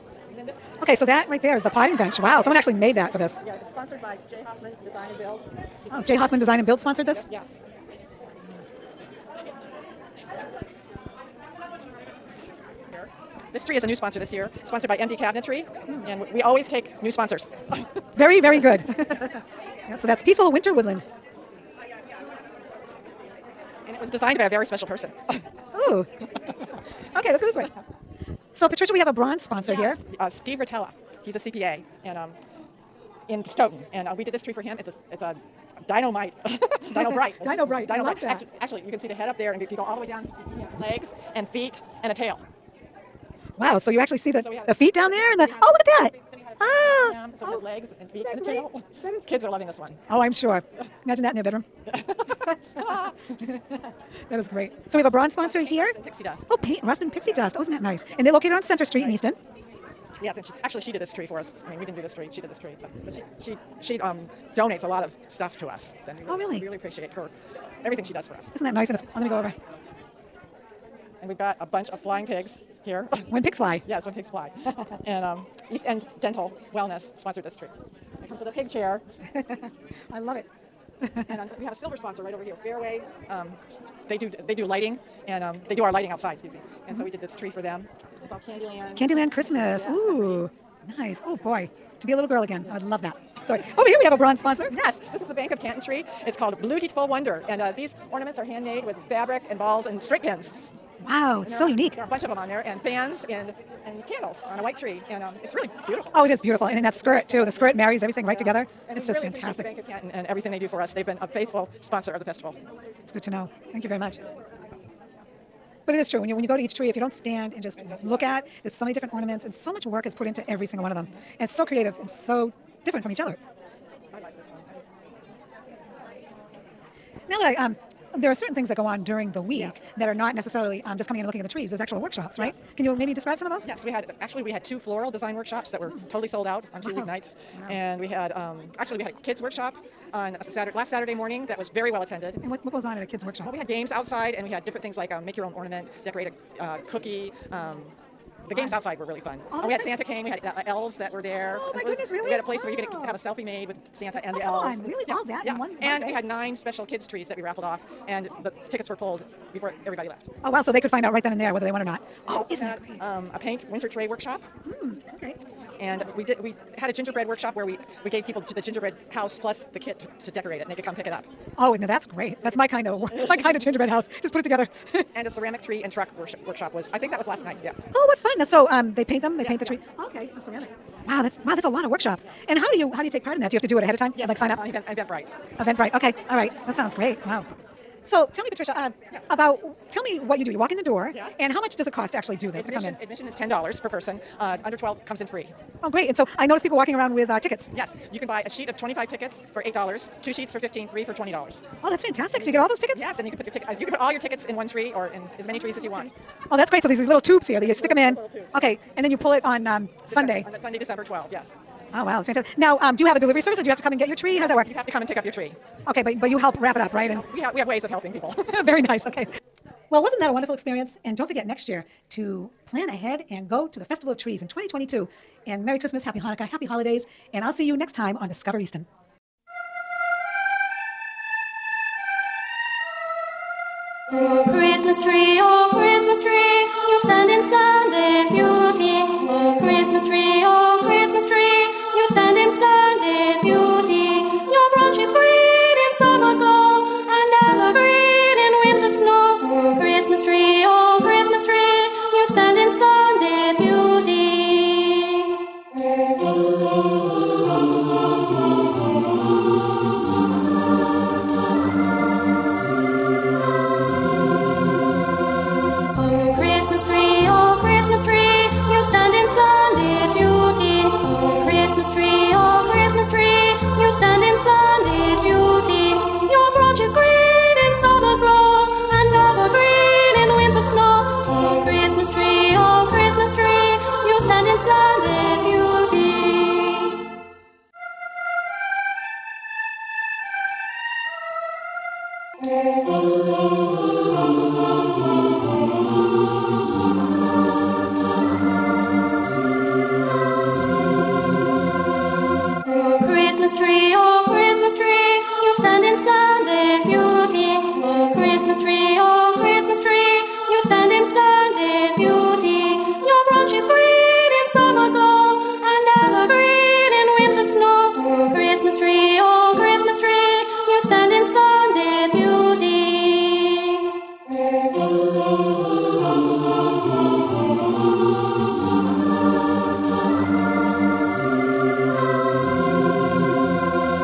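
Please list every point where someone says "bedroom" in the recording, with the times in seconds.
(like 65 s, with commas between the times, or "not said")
51 s.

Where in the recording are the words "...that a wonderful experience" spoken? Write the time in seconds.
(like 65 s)
220 s.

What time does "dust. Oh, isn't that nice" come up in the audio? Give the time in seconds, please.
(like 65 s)
57 s.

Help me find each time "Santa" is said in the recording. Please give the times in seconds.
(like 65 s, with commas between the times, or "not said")
149 s, 153 s.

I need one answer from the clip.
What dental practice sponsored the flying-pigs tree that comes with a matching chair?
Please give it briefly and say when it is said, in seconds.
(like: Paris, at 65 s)
East End Dental Wellness, at 75 s.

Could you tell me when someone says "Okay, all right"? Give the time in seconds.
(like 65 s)
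185 s.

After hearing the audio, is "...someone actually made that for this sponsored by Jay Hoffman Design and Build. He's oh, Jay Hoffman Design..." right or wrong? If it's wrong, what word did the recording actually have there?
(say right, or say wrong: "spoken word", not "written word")
right.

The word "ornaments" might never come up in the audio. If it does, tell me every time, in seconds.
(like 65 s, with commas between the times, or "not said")
98 s, 119 s, 145 s.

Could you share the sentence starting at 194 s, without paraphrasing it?
Uh, under twelve comes in free.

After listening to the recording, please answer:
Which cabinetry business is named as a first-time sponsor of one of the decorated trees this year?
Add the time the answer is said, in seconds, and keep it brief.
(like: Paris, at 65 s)
MD Cabinetry, at 14 s.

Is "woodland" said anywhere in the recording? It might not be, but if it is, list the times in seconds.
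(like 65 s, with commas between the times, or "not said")
20 s.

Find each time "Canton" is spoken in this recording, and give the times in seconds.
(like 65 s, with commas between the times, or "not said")
95 s, 109 s.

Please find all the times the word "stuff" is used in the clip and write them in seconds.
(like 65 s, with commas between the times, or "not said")
65 s.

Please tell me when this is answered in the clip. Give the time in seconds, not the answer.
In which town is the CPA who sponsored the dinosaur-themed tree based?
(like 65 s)
33 s.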